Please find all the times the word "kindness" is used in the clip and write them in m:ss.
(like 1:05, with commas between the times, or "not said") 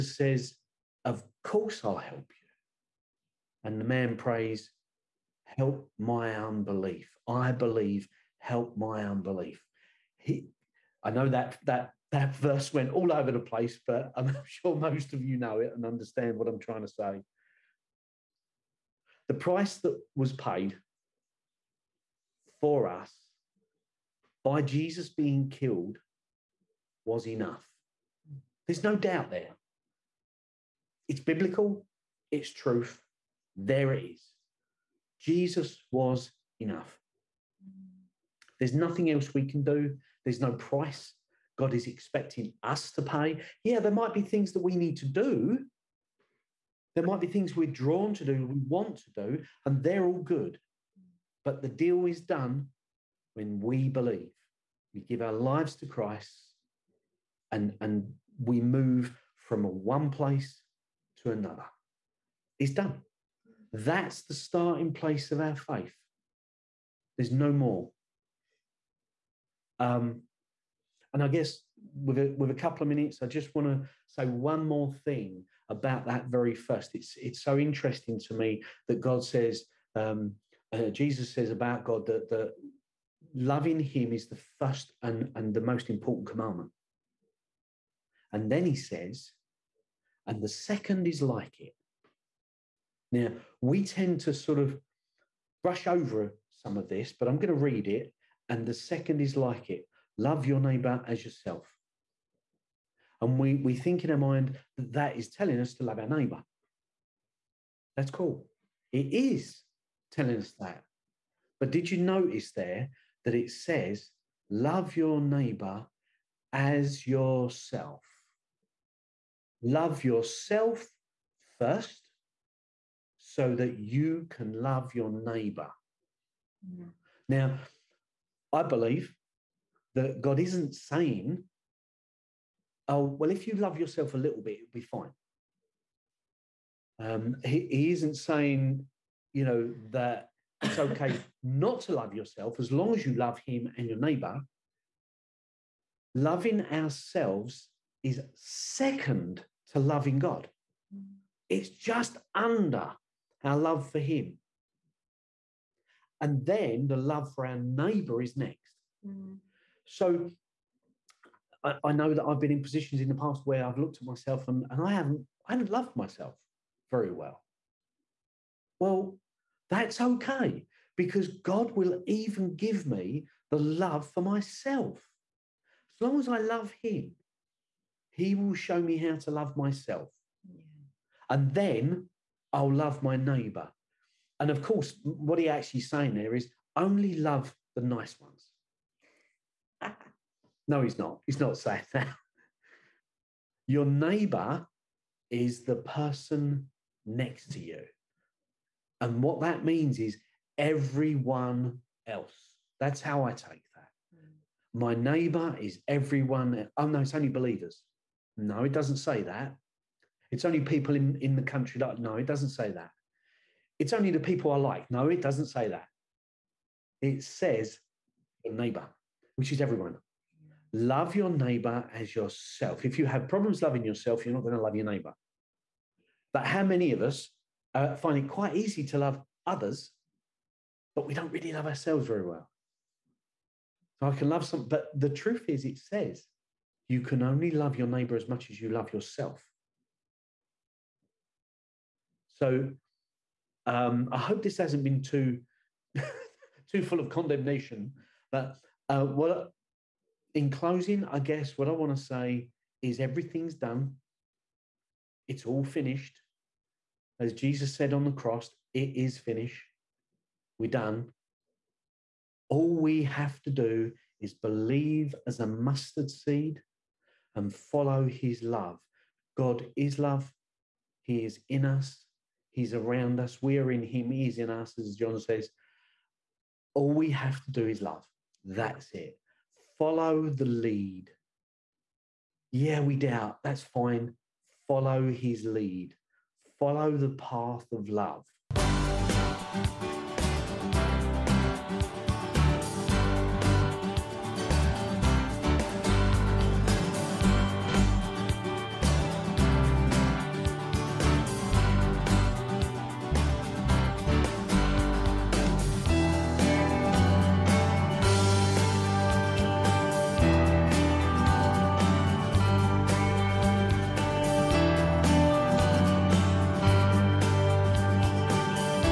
not said.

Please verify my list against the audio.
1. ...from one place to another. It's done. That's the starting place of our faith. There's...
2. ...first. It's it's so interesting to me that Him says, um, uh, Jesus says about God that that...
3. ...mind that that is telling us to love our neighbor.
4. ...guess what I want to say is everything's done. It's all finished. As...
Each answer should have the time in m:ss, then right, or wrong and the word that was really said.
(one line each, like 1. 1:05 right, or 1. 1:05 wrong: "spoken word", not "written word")
1. 0:59 right
2. 1:16 wrong: "God", not "Him"
3. 1:44 right
4. 4:11 right.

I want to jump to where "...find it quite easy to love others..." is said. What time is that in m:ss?
3:47.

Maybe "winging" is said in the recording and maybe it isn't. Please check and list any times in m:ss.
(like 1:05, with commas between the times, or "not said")
not said.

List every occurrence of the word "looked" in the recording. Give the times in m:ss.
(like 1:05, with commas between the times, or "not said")
2:43.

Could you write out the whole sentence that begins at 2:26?
Loving ourselves is second loving God.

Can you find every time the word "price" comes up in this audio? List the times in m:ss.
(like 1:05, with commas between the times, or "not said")
0:19, 0:40.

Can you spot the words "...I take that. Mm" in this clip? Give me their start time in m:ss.
3:23.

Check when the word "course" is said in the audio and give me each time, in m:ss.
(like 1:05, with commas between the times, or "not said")
0:01, 3:04.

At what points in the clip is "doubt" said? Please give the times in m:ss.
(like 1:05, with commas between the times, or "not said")
0:28, 4:42.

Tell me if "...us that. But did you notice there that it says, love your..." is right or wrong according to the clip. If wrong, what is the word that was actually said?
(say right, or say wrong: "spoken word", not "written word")
right.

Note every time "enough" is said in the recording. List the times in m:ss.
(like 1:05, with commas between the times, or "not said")
0:27, 0:36.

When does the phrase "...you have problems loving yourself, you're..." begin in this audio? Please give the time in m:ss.
3:42.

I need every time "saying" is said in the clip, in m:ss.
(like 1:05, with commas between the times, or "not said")
2:10, 2:18, 3:05, 3:11.